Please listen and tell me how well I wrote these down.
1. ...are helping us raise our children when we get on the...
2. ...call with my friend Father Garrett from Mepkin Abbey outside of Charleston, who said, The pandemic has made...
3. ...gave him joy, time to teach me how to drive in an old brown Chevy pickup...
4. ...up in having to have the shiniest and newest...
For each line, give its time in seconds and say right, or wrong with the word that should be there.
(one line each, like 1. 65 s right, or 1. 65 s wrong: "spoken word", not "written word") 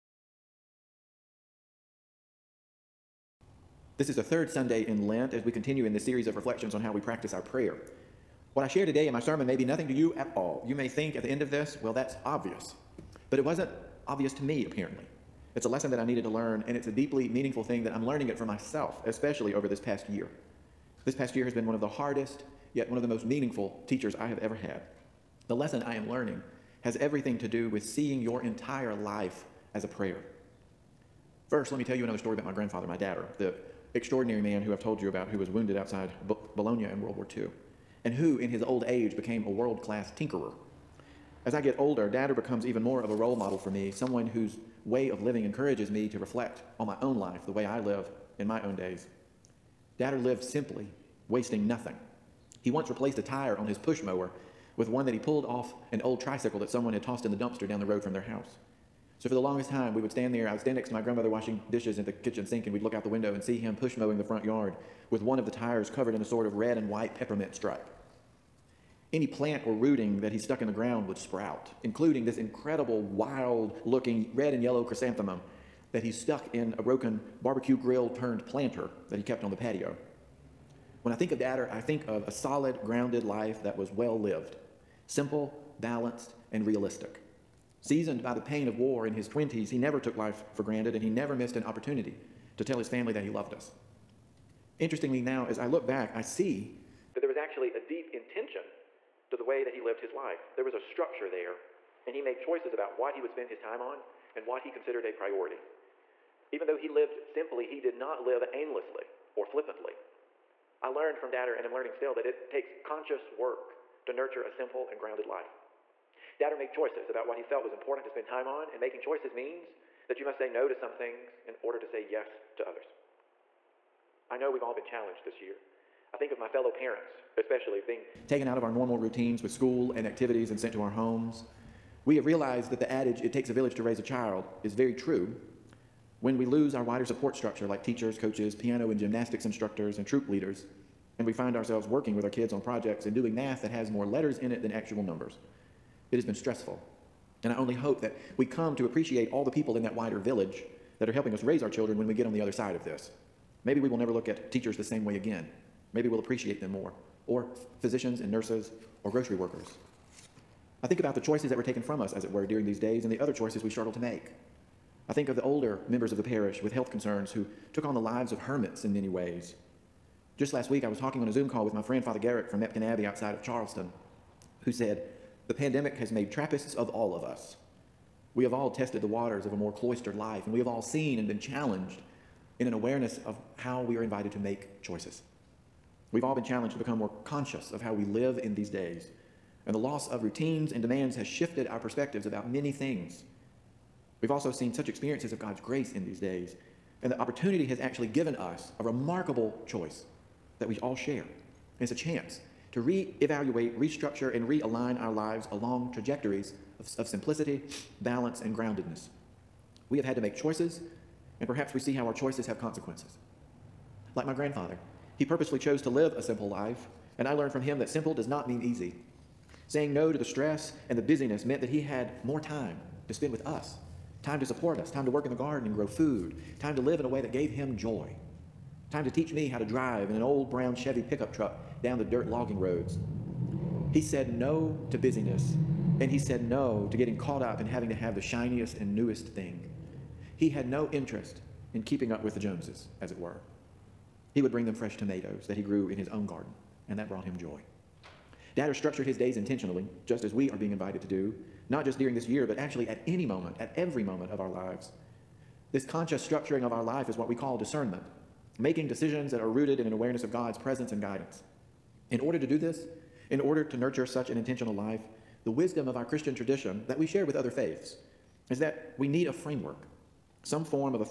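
1. 151 s right
2. 171 s right
3. 227 s right
4. 237 s right.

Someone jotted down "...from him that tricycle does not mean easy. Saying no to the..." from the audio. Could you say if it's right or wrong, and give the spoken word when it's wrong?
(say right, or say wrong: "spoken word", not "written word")
wrong: "simple", not "tricycle".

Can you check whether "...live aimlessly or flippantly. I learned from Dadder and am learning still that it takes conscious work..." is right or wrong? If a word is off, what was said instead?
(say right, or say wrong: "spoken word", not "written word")
right.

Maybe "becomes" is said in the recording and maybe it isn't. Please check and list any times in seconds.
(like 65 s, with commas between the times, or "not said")
42 s, 186 s.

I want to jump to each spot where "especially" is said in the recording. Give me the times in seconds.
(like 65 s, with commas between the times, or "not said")
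19 s, 127 s.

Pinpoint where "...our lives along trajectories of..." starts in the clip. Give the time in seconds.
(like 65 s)
205 s.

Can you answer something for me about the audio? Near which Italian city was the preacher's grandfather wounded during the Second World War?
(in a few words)
Bologna.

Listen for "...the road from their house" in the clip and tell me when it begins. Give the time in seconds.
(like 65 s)
57 s.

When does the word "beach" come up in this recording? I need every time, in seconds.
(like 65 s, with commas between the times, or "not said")
not said.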